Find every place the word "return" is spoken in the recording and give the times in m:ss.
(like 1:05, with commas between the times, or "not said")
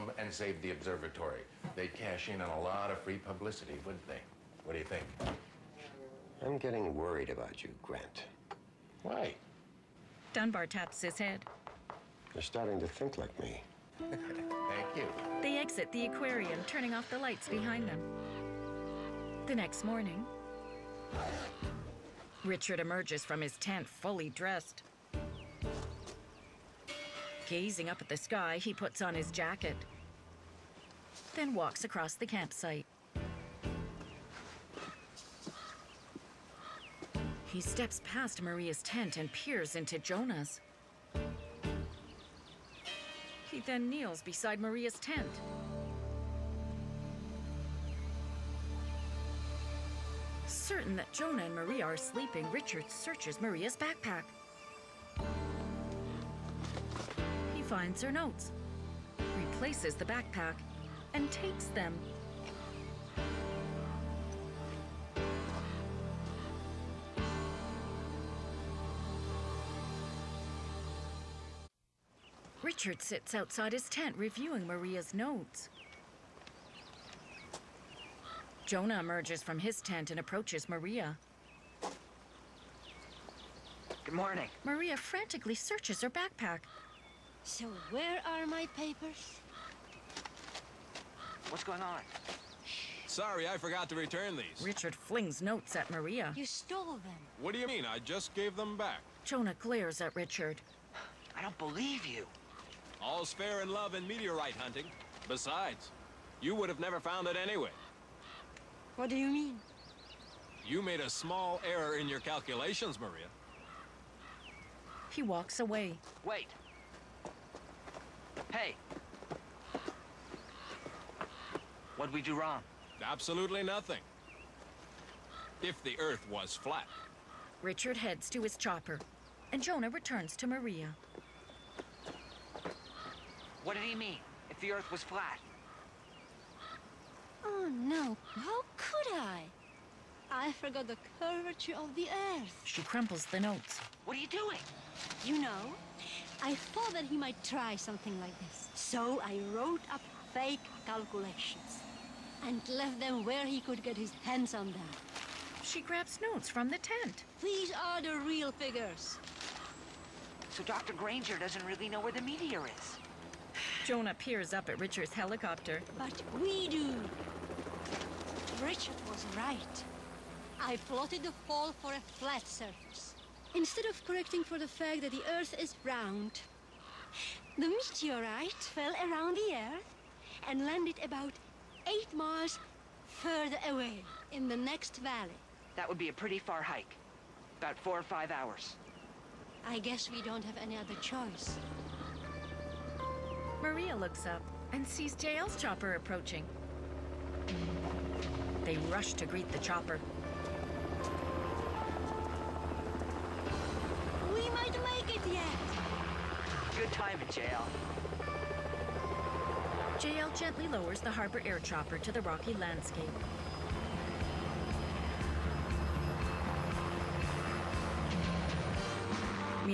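1:33, 2:09.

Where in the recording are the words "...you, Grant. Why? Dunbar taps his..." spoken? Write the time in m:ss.
0:07.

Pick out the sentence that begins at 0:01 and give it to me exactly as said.
They'd cash in on a lot of free publicity, wouldn't they?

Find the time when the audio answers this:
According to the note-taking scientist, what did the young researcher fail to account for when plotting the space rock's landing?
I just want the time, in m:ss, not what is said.
2:21.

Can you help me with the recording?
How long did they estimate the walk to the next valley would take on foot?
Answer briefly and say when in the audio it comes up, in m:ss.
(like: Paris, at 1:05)
4 or 5 hours, at 3:07.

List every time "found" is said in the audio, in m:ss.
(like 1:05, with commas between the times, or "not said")
1:46.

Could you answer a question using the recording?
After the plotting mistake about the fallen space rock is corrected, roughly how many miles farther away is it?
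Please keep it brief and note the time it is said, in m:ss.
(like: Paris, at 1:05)
8, at 3:01.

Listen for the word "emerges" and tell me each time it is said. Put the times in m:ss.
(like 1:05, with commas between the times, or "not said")
0:22, 1:18.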